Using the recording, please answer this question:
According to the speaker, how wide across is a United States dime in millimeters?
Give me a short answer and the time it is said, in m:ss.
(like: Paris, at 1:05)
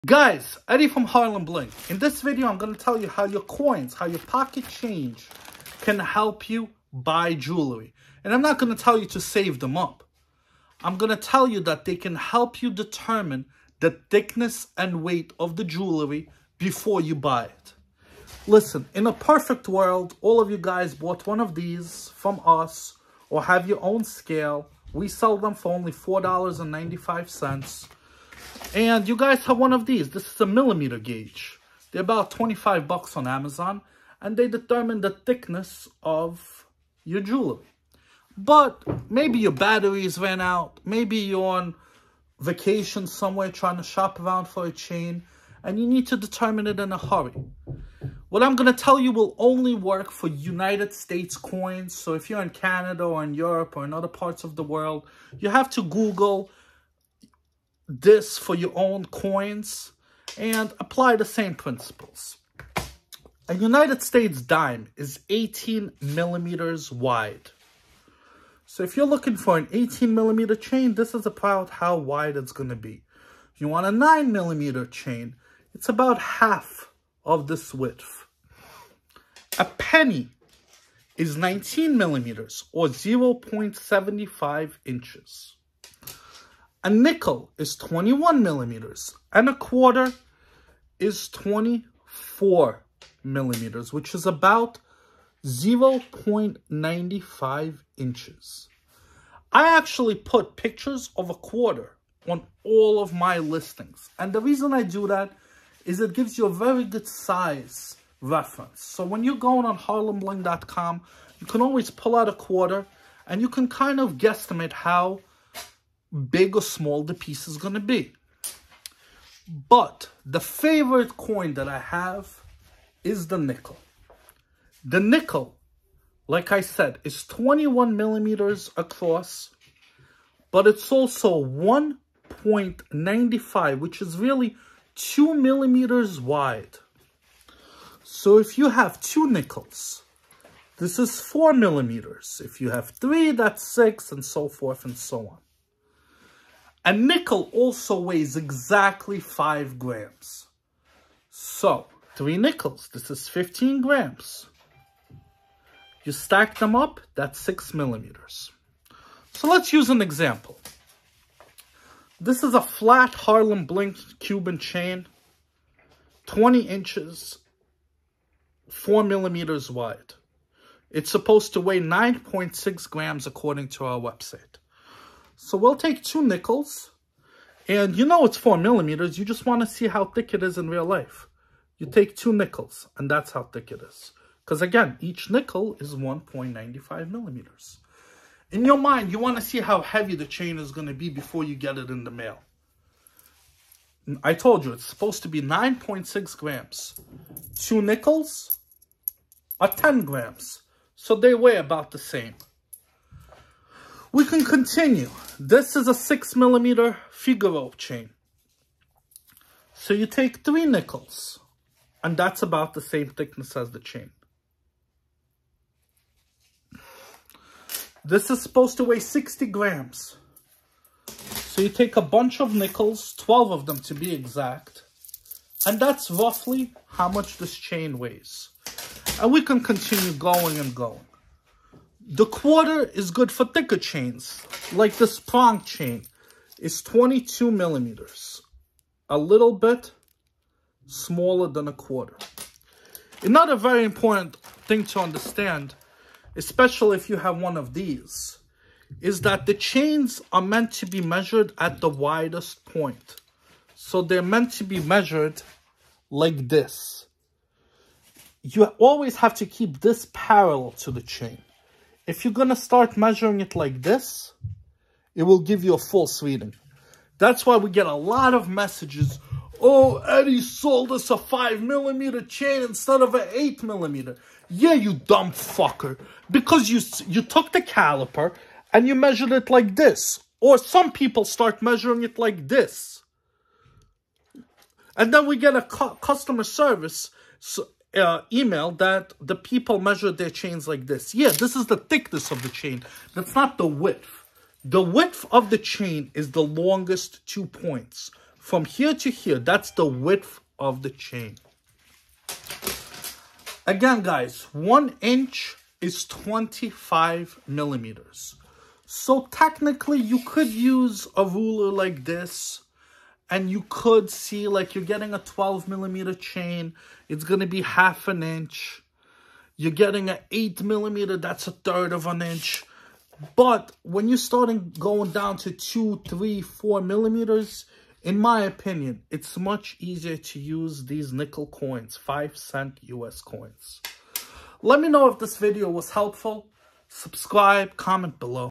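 18 millimeters, at 1:05.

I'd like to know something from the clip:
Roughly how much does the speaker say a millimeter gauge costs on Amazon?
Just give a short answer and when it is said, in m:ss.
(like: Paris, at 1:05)
25 bucks, at 0:32.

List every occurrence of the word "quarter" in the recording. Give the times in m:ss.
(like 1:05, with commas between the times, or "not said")
1:29, 1:41, 1:52, 3:52, 4:01.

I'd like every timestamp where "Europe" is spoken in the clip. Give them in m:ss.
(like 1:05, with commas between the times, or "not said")
0:53.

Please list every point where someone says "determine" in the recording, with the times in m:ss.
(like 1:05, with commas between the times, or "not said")
0:12, 0:34, 0:46.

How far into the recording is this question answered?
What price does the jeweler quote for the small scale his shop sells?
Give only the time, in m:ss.
0:25.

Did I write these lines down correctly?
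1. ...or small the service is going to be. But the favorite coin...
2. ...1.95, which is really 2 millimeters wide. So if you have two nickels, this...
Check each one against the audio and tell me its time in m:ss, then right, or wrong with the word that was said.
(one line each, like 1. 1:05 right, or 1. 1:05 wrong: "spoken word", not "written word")
1. 1:56 wrong: "piece", not "service"
2. 2:11 right.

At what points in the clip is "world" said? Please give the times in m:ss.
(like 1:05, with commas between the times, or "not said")
0:19, 0:54.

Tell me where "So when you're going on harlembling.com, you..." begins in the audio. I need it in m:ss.
1:48.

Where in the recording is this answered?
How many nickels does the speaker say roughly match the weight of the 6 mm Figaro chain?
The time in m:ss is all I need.
3:43.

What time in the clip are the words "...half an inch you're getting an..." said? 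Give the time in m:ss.
5:17.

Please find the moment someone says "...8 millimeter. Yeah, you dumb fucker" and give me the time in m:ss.
4:33.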